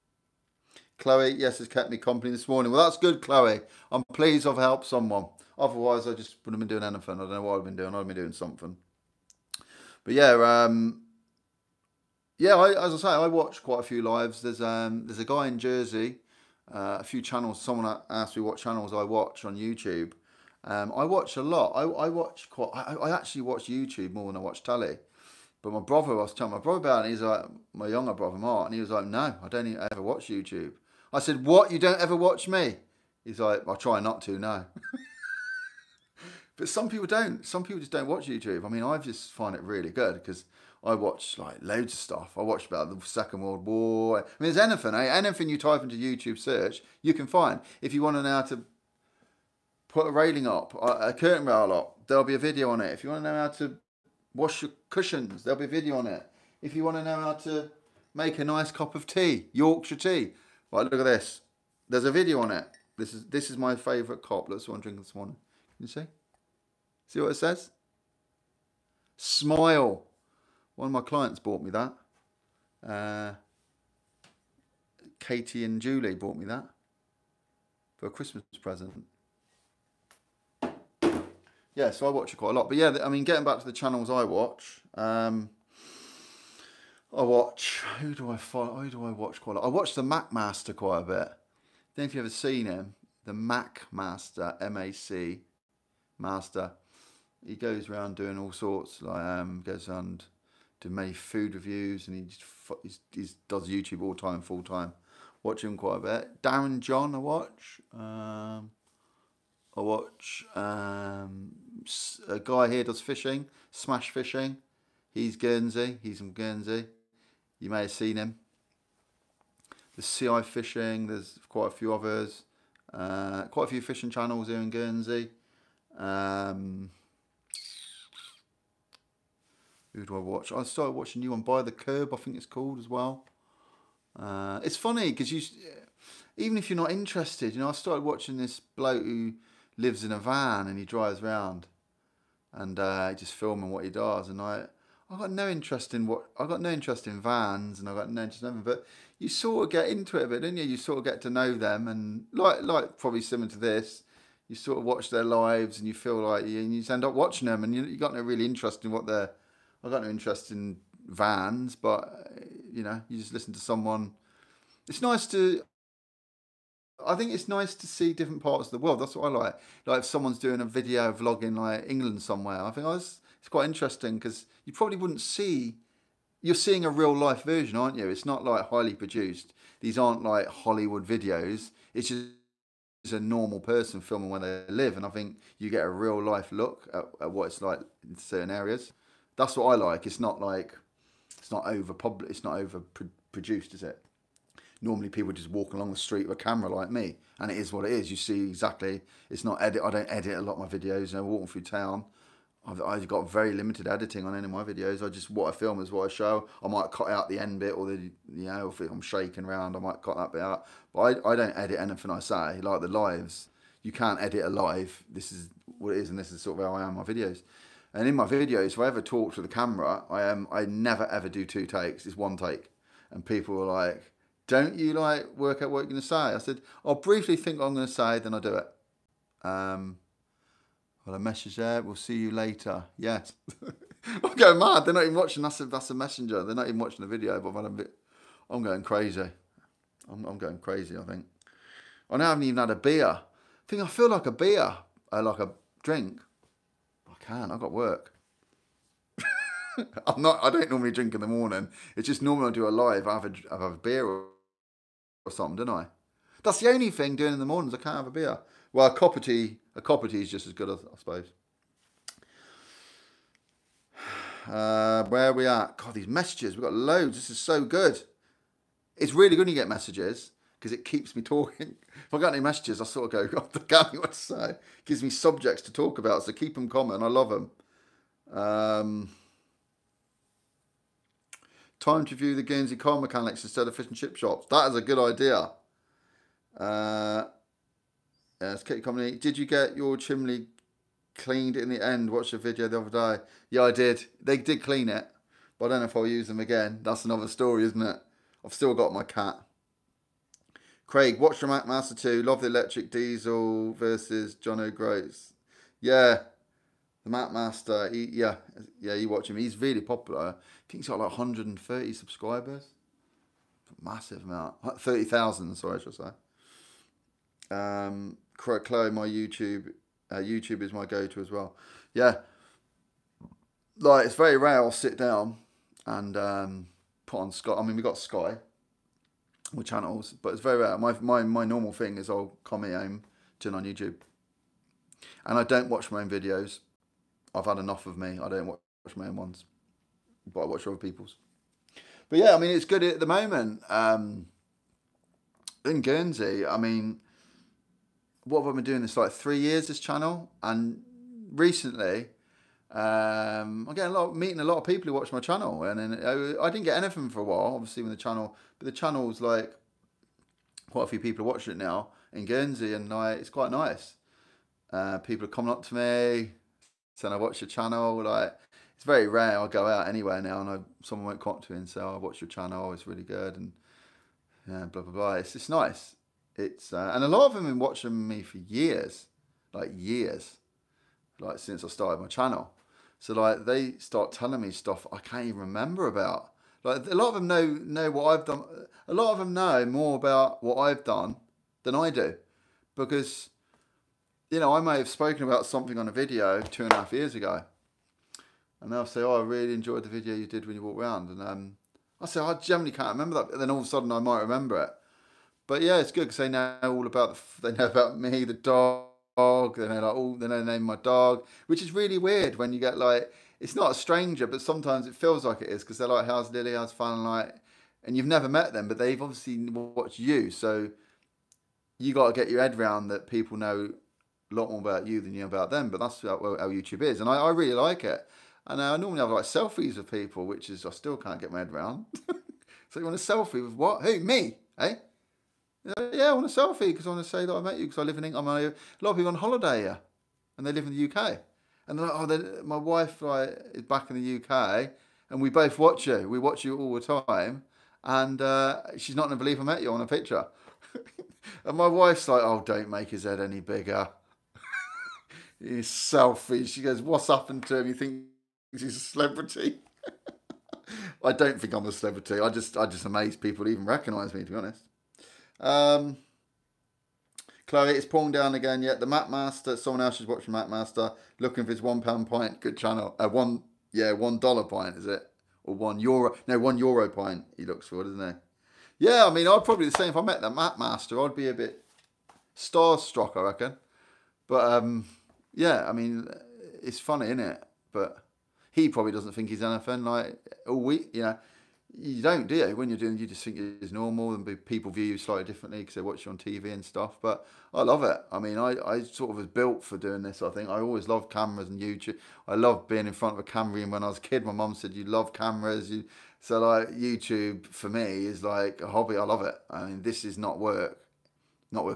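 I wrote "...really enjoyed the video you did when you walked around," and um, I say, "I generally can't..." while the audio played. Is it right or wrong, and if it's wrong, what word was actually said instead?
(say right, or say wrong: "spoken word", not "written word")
right.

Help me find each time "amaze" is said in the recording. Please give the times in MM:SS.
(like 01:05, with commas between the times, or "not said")
07:42.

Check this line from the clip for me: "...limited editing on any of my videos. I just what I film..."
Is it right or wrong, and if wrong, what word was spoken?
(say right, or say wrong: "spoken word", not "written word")
right.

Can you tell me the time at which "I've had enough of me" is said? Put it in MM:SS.
05:37.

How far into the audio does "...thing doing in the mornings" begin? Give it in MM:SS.
04:16.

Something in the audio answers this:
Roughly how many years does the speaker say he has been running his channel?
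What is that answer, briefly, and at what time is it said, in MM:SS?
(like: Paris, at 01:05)
3 years, at 05:49.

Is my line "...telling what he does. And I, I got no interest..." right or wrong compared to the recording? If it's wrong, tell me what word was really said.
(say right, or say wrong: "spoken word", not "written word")
wrong: "filming", not "telling".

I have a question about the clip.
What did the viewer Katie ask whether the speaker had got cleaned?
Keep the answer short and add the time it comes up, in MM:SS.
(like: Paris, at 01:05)
chimney, at 04:49.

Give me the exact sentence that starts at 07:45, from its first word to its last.
Um, Chloe, it's pouring down again.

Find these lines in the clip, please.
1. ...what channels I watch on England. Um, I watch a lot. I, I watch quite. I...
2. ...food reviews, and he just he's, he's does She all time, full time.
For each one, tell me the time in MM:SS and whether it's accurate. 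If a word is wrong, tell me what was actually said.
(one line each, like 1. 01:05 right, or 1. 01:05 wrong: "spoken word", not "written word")
1. 00:18 wrong: "YouTube", not "England"
2. 01:41 wrong: "YouTube", not "She".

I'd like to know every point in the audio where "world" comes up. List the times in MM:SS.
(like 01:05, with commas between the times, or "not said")
00:43, 02:48.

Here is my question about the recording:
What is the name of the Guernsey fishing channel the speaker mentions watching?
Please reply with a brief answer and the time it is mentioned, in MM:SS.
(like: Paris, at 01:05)
Smash Fishing, at 01:53.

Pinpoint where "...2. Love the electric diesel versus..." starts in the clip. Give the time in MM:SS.
05:01.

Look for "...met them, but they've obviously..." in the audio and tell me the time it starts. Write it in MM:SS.
06:58.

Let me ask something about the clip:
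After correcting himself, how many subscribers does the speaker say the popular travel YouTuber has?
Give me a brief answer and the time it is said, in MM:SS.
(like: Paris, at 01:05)
30,000, at 05:14.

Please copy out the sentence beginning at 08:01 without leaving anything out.
I'd be a bit starstruck, I reckon.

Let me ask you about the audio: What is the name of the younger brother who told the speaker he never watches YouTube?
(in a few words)
Mark.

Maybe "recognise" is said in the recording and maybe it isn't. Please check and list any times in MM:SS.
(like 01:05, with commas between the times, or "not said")
07:43.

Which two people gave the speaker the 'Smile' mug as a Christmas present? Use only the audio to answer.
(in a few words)
Katie and Julie.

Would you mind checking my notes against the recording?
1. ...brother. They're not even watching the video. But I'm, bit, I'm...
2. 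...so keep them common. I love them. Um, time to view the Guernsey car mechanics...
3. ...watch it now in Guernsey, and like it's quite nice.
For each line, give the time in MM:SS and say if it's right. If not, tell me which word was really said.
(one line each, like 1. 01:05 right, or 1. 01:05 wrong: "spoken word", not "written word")
1. 03:55 wrong: "messenger", not "brother"
2. 04:36 right
3. 06:01 right.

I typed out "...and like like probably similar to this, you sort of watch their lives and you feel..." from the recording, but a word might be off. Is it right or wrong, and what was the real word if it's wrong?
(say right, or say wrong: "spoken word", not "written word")
right.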